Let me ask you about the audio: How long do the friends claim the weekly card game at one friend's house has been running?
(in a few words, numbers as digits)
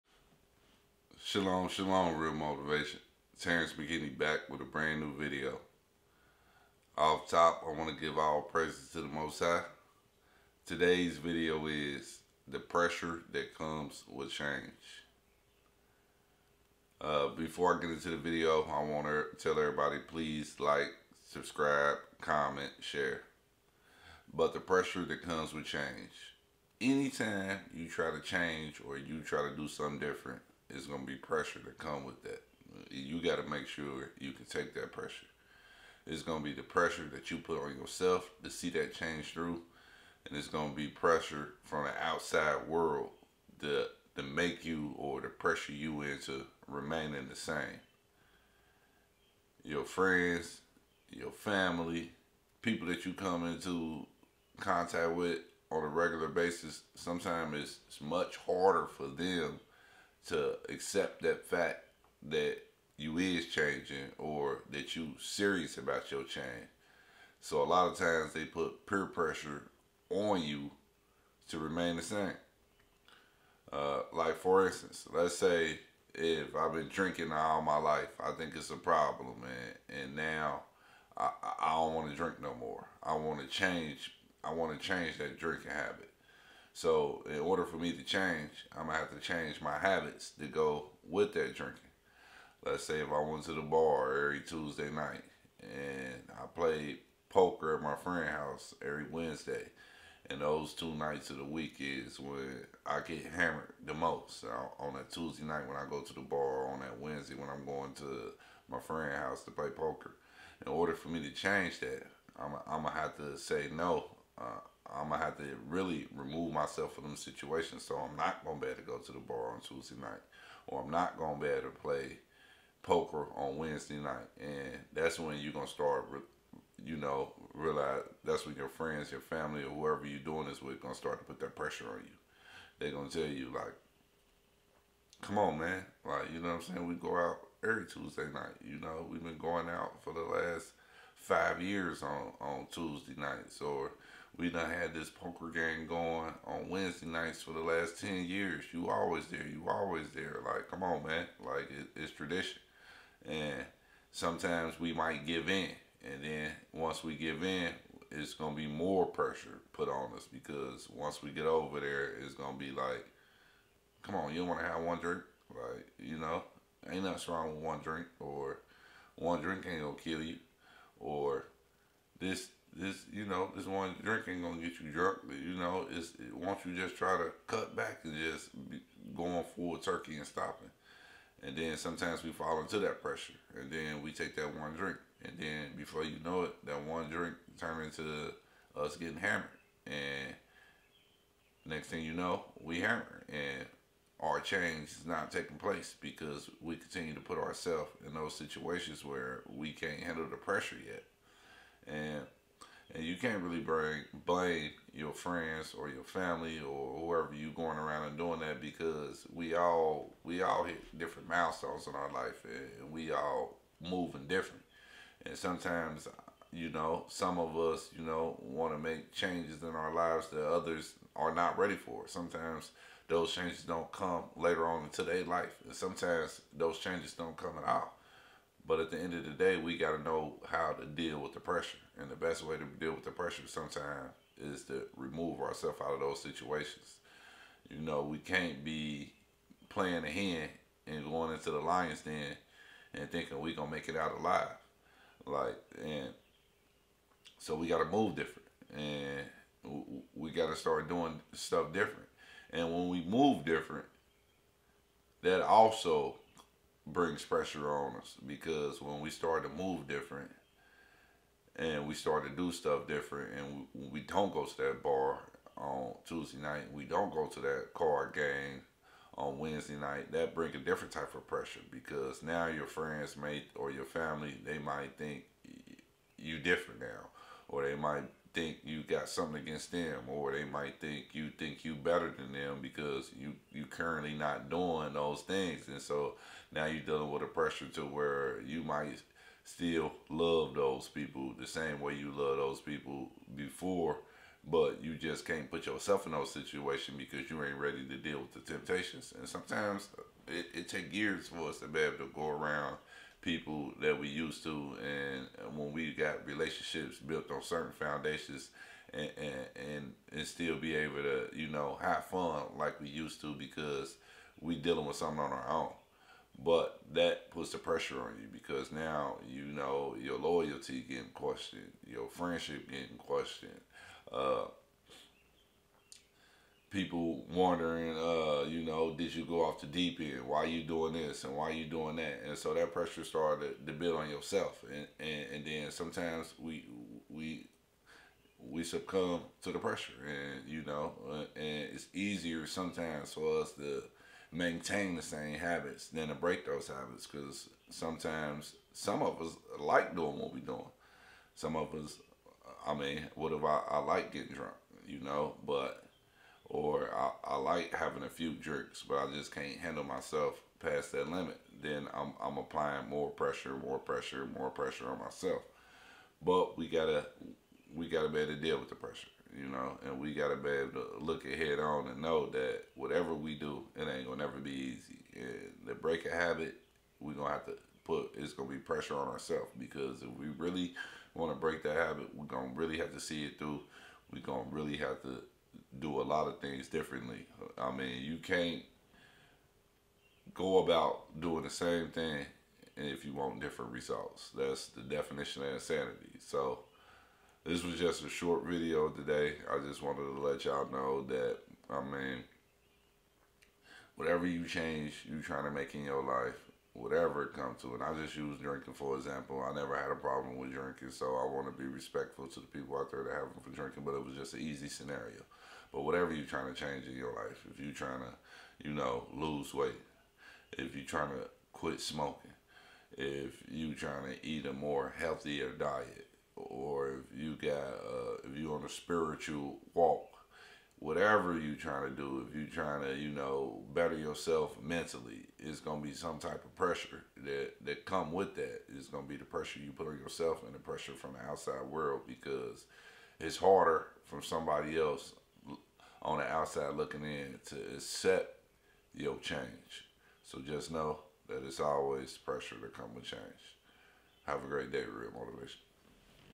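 10 years.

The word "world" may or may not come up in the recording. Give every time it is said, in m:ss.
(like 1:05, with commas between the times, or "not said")
0:42, 7:21.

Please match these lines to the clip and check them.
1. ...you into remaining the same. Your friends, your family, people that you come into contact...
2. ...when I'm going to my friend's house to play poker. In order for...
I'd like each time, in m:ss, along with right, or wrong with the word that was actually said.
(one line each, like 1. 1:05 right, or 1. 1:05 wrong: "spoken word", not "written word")
1. 0:45 right
2. 1:47 right.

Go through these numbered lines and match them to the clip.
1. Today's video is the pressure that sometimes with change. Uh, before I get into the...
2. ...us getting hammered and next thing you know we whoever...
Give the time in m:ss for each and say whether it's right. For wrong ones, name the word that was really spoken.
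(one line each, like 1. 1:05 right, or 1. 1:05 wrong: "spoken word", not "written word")
1. 0:10 wrong: "comes", not "sometimes"
2. 3:08 wrong: "hammer", not "whoever".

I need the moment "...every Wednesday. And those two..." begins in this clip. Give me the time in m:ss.
1:38.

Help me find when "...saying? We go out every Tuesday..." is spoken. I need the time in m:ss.
2:16.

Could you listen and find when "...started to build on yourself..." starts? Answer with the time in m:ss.
5:33.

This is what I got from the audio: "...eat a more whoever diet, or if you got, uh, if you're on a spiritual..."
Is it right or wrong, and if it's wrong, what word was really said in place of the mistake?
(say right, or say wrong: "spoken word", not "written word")
wrong: "healthier", not "whoever".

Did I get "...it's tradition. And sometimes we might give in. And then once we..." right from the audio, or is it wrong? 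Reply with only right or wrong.
right.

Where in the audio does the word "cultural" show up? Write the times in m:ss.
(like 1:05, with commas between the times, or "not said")
not said.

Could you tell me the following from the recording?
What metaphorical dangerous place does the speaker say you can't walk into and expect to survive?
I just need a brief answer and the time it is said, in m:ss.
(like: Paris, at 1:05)
The lion's den, at 4:01.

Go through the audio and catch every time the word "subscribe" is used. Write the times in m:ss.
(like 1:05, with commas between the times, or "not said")
0:21.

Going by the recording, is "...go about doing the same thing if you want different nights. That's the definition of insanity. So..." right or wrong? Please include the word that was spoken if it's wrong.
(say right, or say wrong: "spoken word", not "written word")
wrong: "results", not "nights".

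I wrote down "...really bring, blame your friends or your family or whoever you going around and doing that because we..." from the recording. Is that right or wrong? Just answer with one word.
right.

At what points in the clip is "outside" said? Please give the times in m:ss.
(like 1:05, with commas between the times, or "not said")
0:42, 7:21, 7:26.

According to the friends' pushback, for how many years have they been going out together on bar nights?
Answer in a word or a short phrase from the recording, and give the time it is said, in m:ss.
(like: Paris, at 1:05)
5 years, at 2:21.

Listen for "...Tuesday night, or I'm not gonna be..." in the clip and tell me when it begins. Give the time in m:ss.
1:59.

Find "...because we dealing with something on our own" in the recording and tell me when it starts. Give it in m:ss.
5:13.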